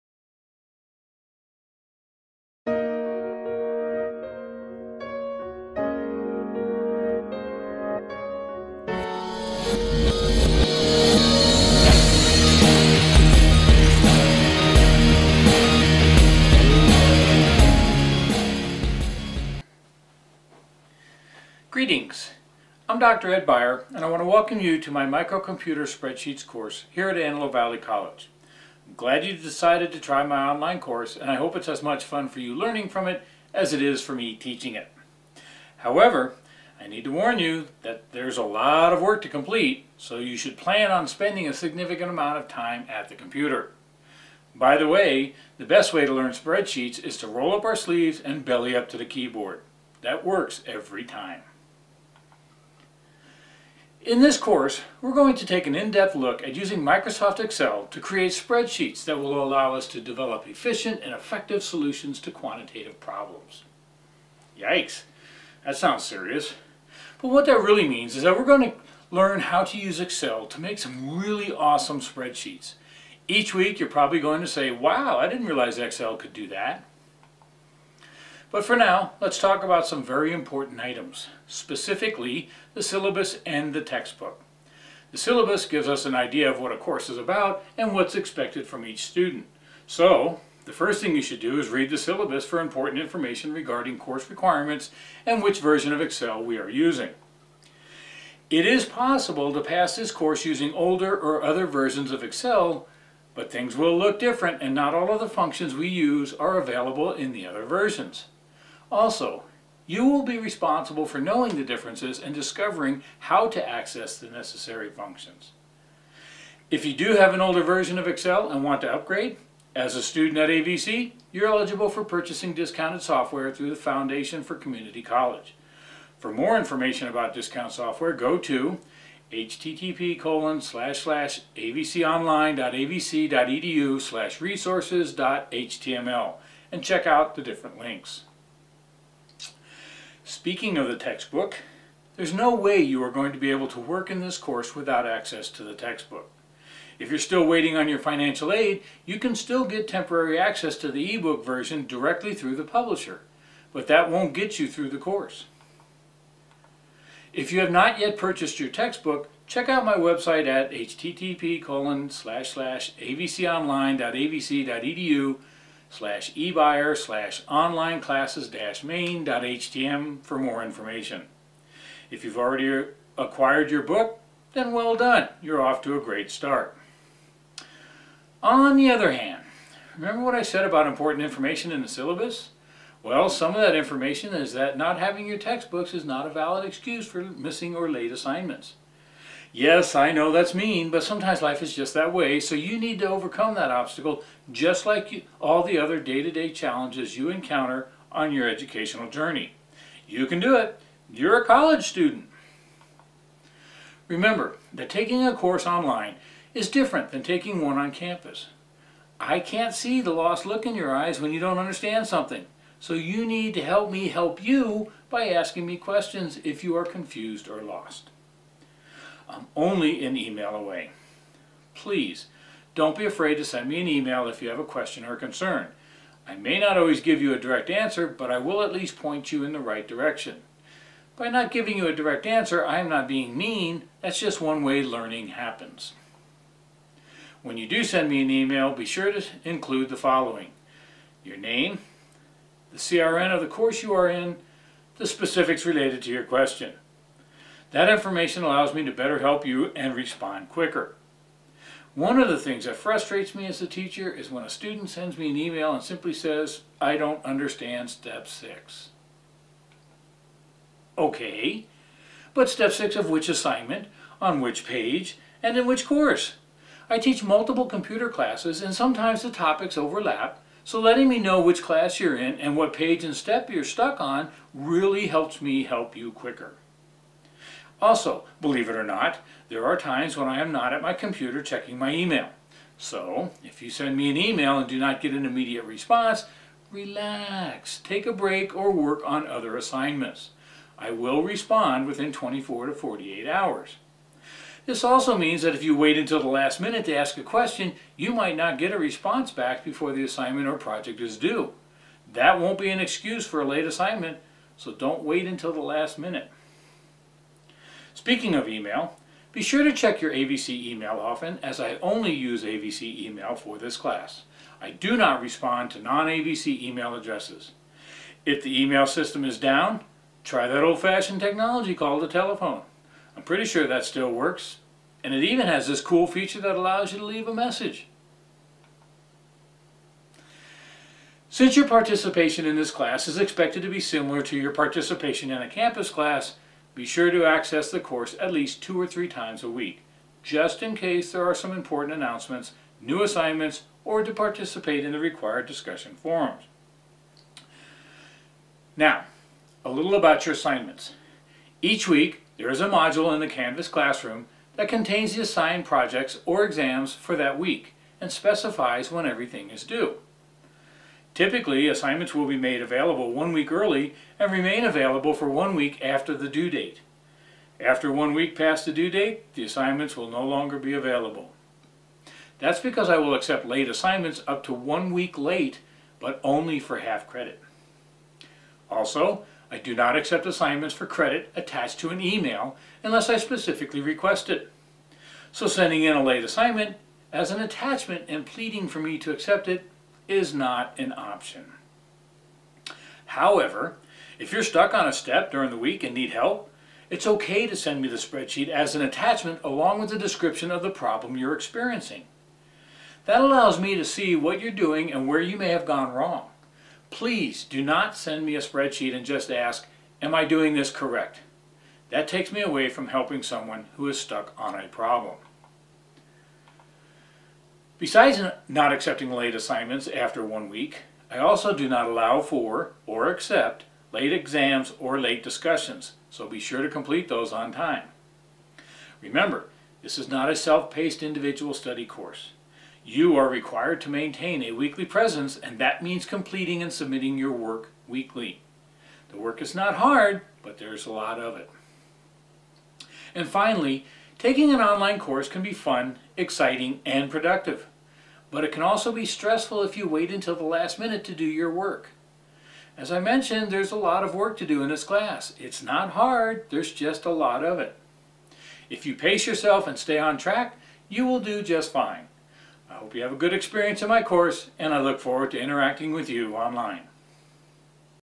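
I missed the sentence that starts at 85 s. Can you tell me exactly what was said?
The syllabus gives us an idea of what a course is about and what's expected from each student.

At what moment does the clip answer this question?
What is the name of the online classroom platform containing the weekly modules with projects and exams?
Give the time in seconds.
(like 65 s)
353 s.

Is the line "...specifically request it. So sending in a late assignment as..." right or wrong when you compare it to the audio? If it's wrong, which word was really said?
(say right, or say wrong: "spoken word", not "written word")
right.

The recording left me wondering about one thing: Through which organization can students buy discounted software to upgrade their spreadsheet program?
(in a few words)
Foundation for Community College.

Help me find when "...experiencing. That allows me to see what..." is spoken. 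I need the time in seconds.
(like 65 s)
401 s.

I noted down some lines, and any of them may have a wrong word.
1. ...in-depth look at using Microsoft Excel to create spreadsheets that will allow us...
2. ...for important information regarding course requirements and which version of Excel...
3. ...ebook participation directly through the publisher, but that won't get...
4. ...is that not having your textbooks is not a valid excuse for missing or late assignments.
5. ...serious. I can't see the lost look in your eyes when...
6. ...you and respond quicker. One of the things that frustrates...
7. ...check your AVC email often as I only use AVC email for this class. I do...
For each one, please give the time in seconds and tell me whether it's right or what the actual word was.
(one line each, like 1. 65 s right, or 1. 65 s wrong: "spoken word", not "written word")
1. 55 s right
2. 92 s right
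3. 151 s wrong: "version", not "participation"
4. 184 s right
5. 207 s wrong: "campus", not "serious"
6. 249 s right
7. 309 s right.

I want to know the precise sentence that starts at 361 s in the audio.
Typically, assignments will be made available one week early and remain available for one week after the due date.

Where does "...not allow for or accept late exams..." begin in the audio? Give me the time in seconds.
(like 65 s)
421 s.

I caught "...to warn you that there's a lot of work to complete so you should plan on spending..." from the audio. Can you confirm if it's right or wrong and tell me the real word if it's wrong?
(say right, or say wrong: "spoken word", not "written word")
right.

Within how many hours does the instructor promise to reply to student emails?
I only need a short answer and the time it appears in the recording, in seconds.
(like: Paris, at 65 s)
24 to 48 hours, at 292 s.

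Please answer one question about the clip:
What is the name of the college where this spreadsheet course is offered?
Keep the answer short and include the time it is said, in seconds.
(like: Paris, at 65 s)
Antelope Valley College, at 27 s.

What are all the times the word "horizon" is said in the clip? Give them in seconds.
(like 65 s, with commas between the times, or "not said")
not said.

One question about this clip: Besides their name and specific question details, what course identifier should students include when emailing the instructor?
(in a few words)
CRN.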